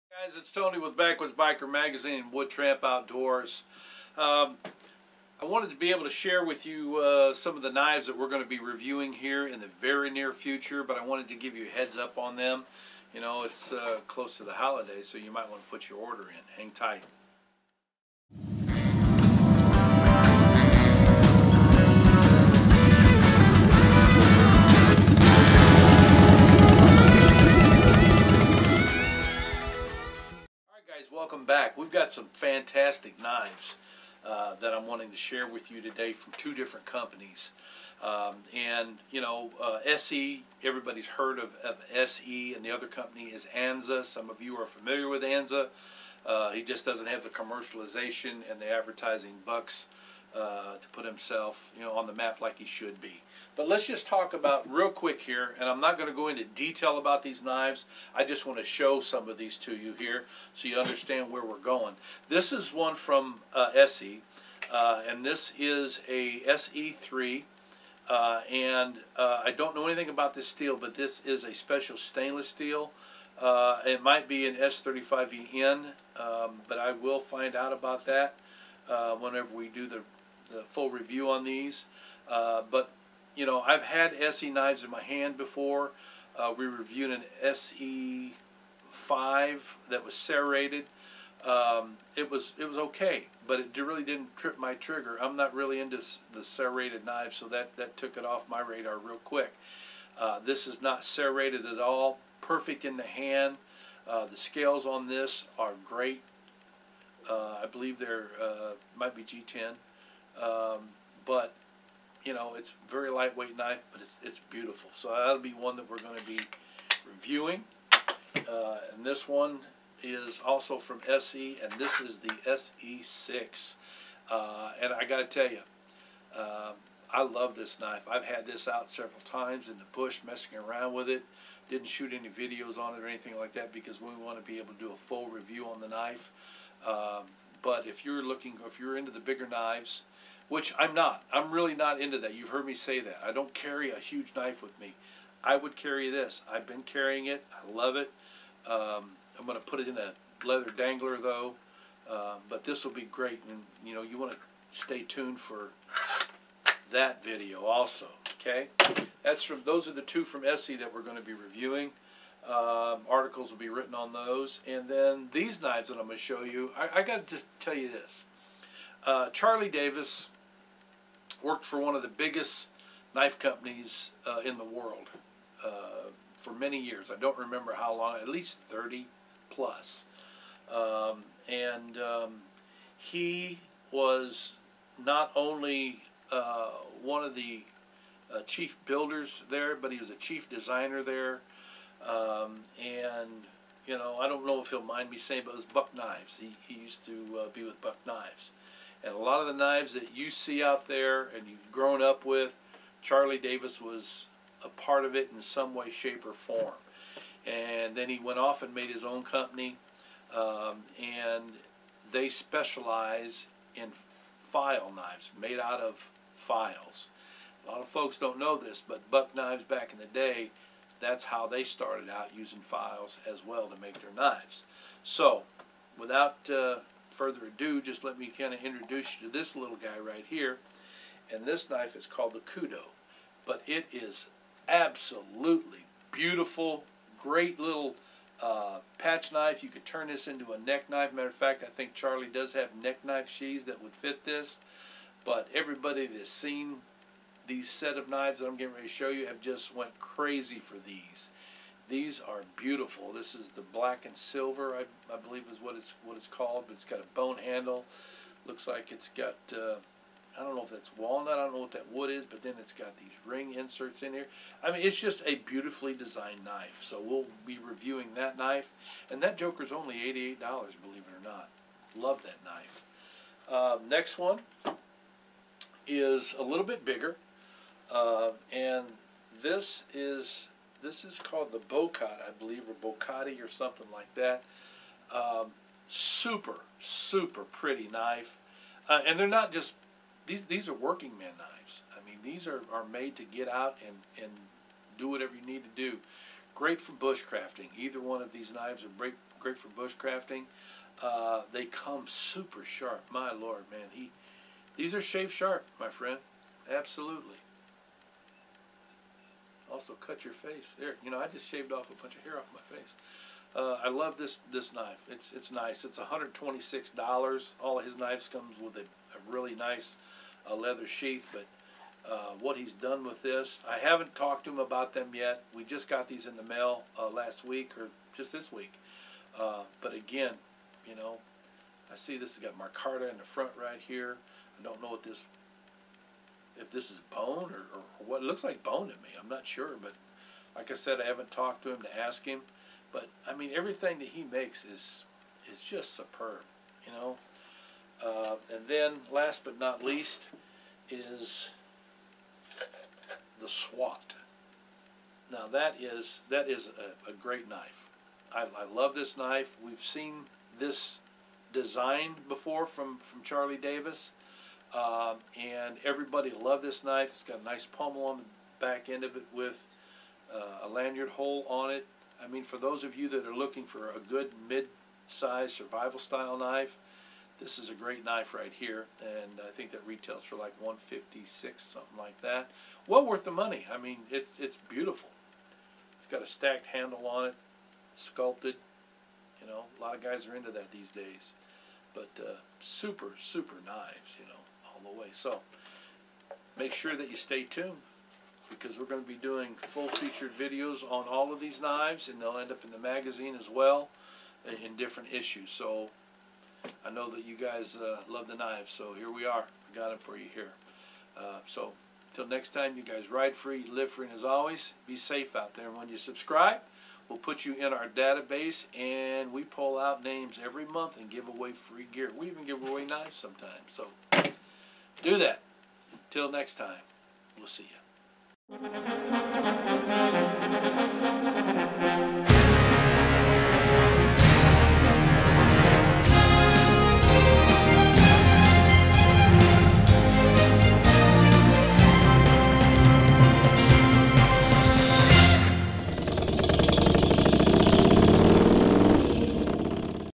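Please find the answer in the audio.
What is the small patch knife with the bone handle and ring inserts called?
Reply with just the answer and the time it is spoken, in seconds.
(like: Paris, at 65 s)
Kudo, at 232 s.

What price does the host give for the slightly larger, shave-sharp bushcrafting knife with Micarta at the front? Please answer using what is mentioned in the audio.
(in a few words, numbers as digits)
$126.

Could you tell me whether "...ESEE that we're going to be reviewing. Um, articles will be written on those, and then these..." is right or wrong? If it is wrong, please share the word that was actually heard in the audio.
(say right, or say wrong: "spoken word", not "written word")
right.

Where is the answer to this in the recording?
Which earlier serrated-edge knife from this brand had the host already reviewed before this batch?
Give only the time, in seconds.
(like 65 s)
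87 s.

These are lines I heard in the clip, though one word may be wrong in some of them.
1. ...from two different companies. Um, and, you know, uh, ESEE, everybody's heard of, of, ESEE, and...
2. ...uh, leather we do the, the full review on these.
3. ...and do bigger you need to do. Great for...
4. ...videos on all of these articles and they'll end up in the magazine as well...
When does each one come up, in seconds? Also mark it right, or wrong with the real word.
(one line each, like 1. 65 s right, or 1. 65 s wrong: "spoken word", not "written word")
1. 36 s right
2. 78 s wrong: "whenever", not "leather"
3. 294 s wrong: "whatever", not "bigger"
4. 400 s wrong: "knives", not "articles".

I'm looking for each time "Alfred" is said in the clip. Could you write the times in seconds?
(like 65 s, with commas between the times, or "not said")
not said.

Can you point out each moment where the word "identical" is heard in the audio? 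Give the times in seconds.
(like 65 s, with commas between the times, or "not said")
not said.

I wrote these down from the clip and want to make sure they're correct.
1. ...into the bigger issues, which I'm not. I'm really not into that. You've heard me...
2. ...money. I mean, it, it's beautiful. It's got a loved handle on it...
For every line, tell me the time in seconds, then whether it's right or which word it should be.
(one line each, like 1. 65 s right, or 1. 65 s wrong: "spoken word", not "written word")
1. 138 s wrong: "knives", not "issues"
2. 383 s wrong: "stacked", not "loved".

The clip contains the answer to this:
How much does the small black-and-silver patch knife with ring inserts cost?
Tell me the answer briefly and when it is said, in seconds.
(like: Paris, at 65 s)
$88, at 269 s.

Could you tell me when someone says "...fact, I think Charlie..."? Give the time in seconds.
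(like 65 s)
241 s.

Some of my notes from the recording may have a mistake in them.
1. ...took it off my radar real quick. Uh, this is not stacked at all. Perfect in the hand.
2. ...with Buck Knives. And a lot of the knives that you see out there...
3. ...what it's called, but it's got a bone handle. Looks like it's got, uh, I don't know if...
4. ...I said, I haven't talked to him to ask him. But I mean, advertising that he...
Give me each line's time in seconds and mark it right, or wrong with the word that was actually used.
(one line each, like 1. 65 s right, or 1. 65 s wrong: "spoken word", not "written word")
1. 97 s wrong: "serrated", not "stacked"
2. 197 s right
3. 256 s right
4. 340 s wrong: "everything", not "advertising".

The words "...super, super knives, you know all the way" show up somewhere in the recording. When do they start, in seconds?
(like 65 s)
392 s.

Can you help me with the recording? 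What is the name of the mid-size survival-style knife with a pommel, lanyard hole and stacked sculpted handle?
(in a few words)
SWAT.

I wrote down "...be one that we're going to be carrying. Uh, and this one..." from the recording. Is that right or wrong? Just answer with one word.
wrong.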